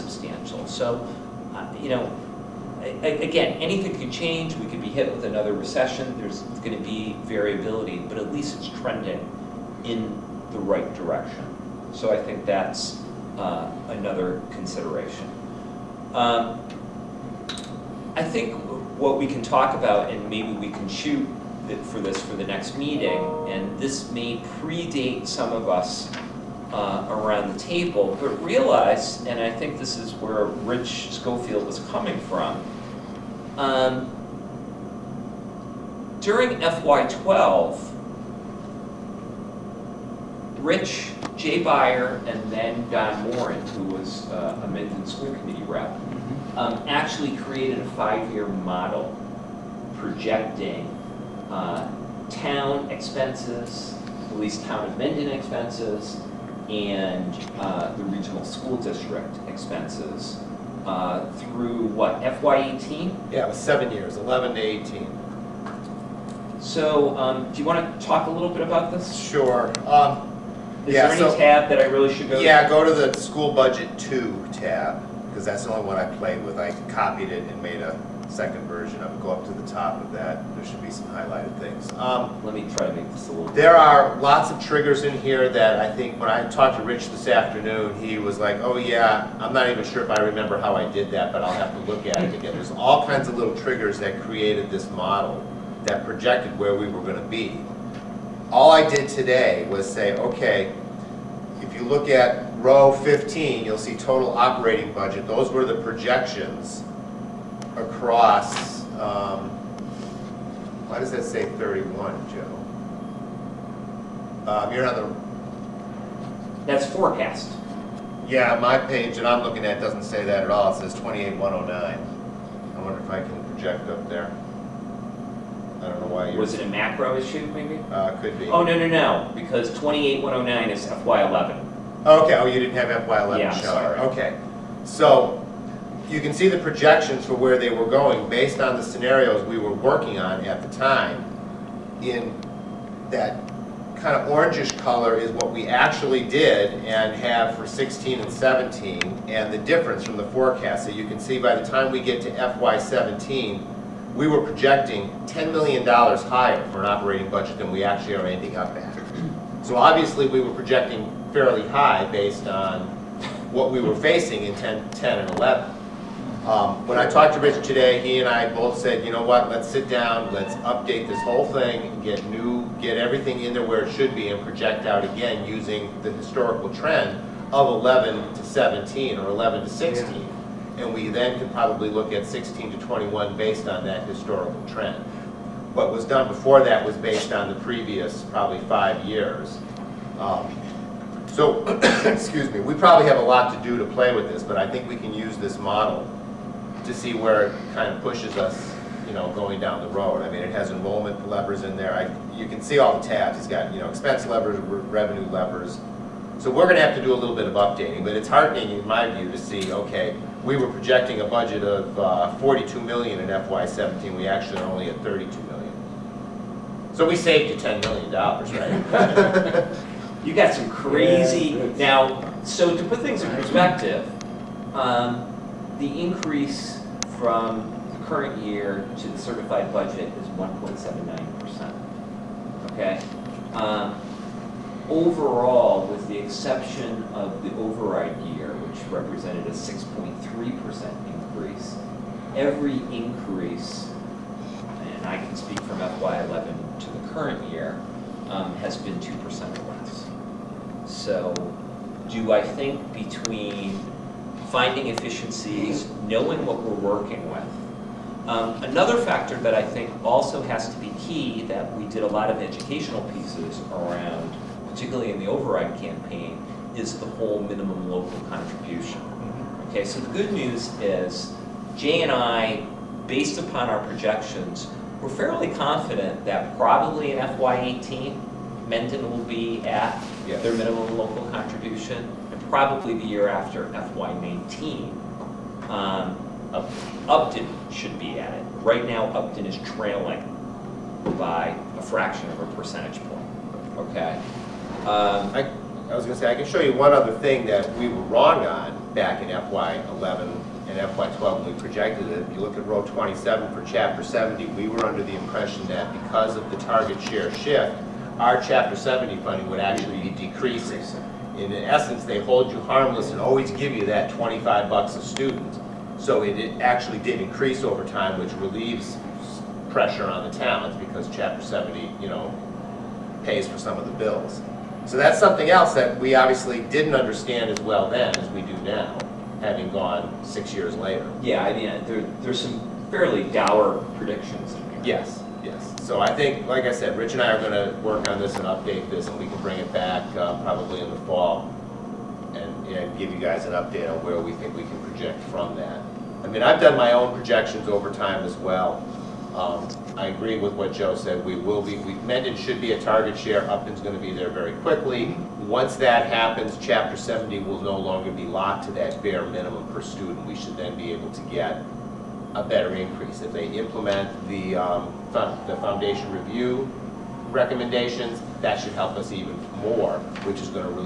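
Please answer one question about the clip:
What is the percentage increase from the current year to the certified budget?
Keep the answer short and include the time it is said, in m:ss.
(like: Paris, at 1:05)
1.79%, at 3:50.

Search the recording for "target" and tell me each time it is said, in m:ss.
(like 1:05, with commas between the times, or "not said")
5:06, 5:52.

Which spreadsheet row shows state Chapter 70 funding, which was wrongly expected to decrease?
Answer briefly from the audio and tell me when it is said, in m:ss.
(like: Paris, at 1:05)
27, at 5:02.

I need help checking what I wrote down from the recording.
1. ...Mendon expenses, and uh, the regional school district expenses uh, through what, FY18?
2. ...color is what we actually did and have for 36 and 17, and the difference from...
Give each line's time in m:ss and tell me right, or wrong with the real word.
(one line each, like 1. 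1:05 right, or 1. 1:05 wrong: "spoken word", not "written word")
1. 0:54 right
2. 2:24 wrong: "16", not "36".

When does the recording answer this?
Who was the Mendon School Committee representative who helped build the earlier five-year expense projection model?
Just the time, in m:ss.
0:42.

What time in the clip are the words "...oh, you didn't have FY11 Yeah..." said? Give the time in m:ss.
2:12.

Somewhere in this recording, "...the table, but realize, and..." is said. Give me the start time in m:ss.
0:27.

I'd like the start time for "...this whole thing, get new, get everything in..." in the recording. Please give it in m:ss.
2:51.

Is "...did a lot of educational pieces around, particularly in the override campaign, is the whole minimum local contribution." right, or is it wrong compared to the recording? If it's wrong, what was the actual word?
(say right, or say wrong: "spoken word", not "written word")
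right.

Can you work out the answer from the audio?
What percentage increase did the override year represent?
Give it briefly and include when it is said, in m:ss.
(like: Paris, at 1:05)
6.3%, at 3:59.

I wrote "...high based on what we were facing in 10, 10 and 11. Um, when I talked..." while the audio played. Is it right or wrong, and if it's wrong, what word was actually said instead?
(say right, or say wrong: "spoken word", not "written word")
right.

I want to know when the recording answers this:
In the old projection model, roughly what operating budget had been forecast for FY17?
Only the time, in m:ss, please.
3:32.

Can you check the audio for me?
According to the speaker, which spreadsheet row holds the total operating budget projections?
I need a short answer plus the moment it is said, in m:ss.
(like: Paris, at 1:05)
15, at 1:43.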